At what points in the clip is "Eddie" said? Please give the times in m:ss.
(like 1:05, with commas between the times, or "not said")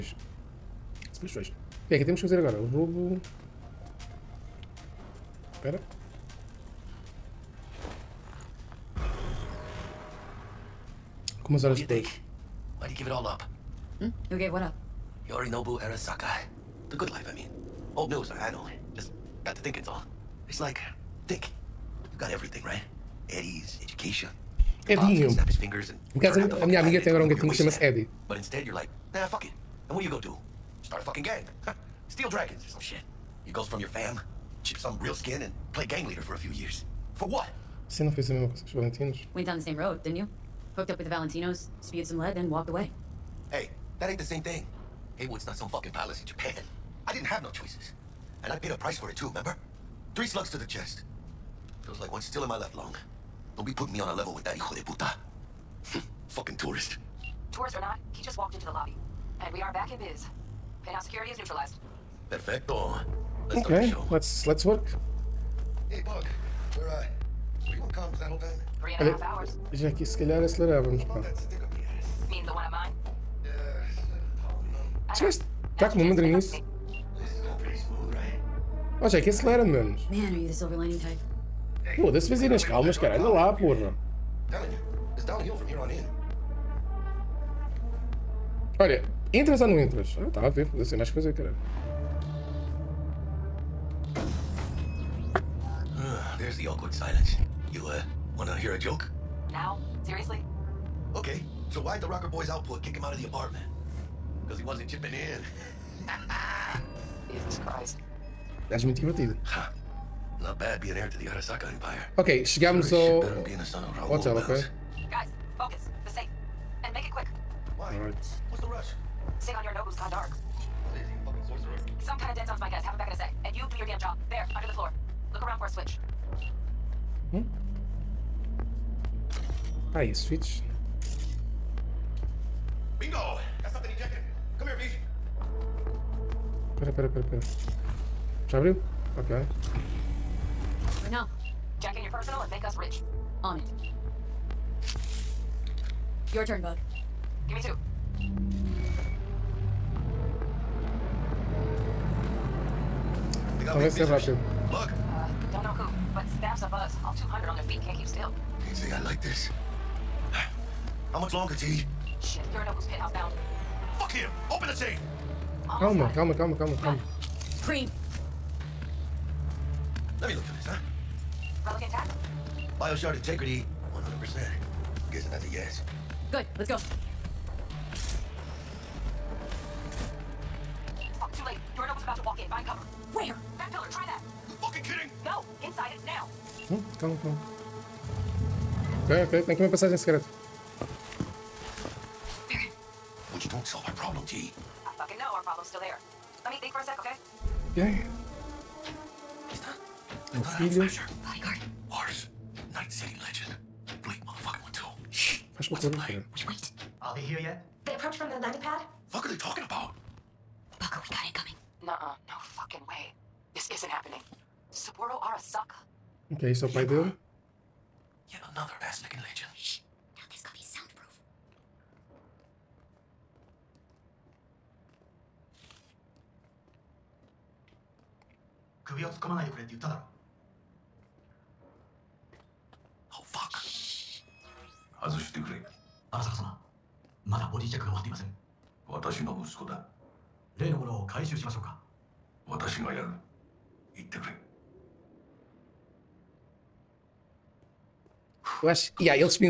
0:23, 0:27.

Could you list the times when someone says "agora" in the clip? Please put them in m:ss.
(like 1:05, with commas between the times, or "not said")
0:02, 0:27.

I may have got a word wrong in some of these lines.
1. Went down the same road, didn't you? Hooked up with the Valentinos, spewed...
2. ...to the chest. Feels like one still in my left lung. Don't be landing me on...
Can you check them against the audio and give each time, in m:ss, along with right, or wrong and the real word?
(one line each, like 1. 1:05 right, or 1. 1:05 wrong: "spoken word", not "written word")
1. 0:39 right
2. 0:50 wrong: "putting", not "landing".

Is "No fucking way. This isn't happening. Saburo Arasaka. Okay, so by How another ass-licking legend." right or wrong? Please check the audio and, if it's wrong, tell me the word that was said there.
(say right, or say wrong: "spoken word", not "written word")
wrong: "Yet", not "How".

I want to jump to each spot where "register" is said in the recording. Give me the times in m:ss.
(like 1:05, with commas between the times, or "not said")
not said.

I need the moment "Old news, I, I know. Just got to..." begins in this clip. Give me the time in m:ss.
0:17.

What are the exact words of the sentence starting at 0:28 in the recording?
But instead you're like, nah, fuck it.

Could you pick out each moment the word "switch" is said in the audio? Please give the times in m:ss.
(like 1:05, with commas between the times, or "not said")
2:05, 2:10.